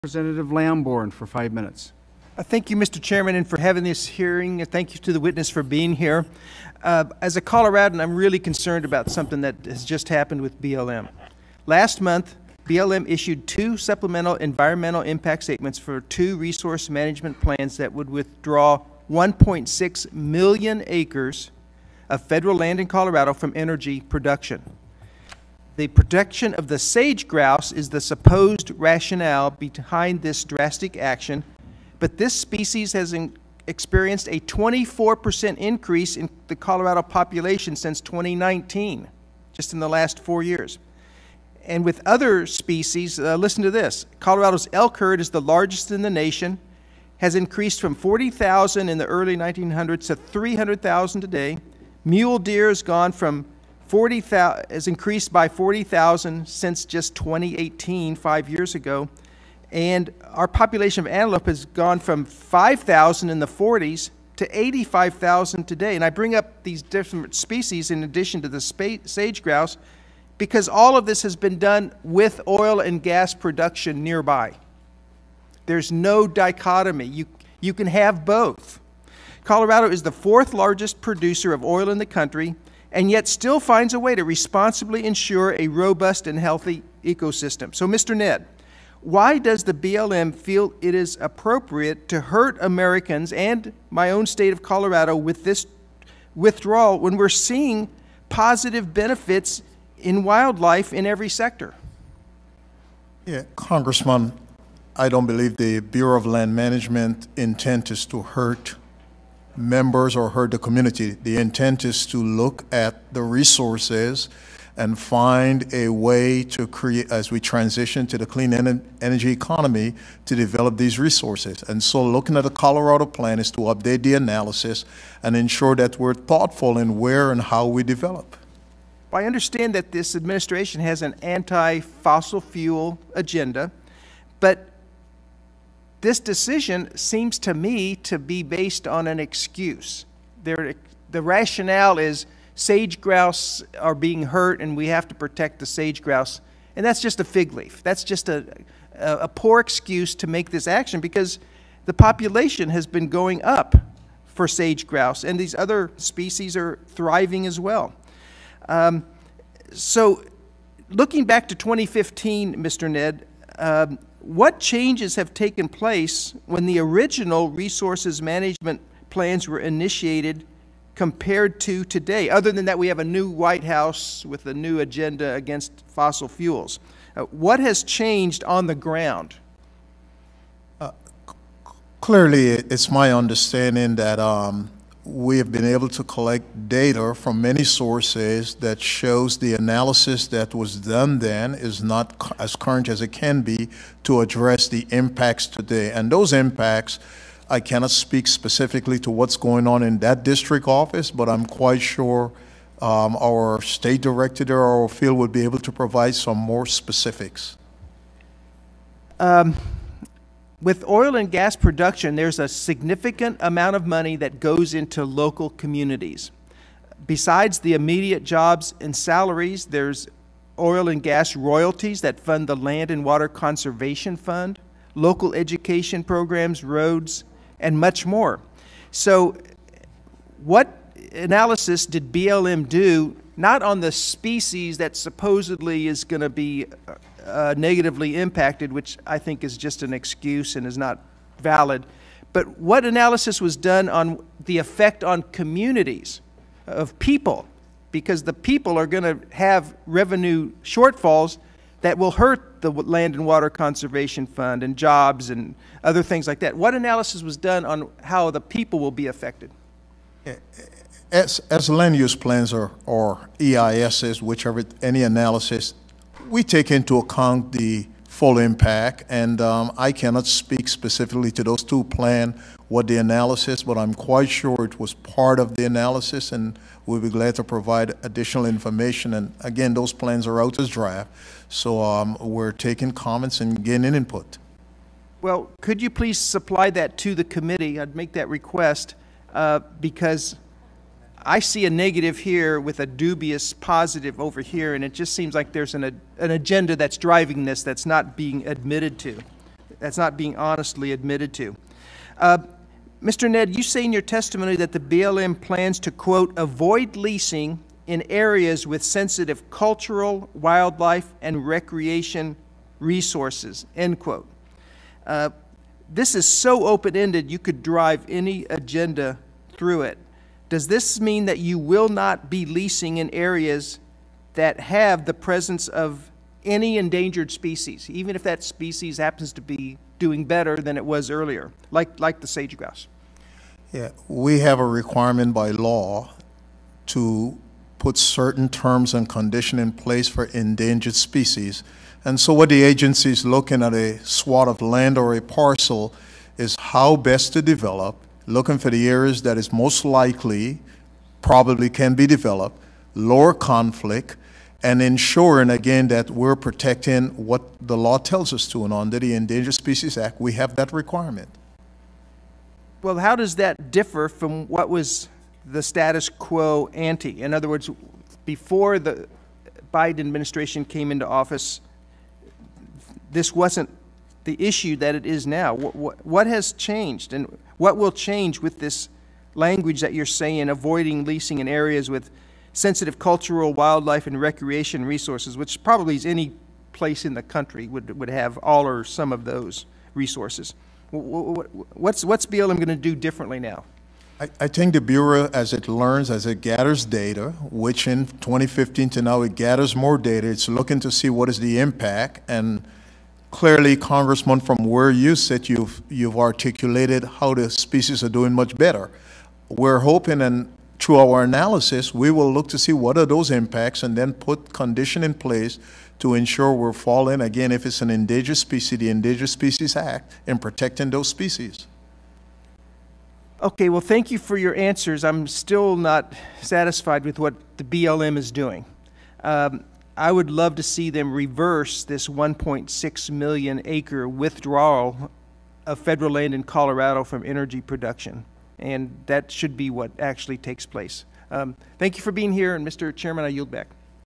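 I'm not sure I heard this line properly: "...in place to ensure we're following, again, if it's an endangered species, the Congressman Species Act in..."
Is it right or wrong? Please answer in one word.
wrong.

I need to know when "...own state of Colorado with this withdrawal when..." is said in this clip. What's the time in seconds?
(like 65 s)
94 s.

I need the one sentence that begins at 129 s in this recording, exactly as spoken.
I understand that this administration has an anti-fossil fuel agenda, but this decision seems to me to be based on an excuse.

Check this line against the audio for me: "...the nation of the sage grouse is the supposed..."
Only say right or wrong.
wrong.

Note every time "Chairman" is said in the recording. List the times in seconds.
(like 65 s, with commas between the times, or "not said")
2 s, 442 s.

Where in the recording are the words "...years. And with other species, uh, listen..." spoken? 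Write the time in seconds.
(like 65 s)
40 s.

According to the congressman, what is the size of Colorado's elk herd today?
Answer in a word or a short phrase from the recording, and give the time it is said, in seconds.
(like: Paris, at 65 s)
300,000, at 50 s.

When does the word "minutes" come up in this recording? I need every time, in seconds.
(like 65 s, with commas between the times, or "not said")
1 s.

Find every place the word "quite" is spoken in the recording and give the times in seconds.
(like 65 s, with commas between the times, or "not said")
201 s, 273 s.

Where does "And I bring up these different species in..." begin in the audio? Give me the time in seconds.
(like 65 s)
65 s.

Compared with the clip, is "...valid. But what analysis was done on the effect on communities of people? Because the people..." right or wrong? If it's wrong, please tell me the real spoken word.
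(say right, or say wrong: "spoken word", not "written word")
right.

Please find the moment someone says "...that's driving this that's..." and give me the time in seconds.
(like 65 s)
296 s.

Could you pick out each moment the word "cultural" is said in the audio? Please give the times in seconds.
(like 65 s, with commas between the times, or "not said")
309 s, 382 s.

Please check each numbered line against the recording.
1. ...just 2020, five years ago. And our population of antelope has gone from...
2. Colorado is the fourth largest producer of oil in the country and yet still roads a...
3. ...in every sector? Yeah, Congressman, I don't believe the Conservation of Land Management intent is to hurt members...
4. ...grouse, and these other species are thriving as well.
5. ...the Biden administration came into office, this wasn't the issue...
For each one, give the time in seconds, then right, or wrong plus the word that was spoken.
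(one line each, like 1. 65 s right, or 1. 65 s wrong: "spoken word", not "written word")
1. 56 s wrong: "2018", not "2020"
2. 79 s wrong: "finds", not "roads"
3. 100 s wrong: "Bureau", not "Conservation"
4. 154 s right
5. 368 s right.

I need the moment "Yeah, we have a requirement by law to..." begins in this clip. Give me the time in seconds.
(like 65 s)
333 s.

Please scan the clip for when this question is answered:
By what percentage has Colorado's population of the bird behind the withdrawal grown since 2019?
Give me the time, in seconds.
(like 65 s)
34 s.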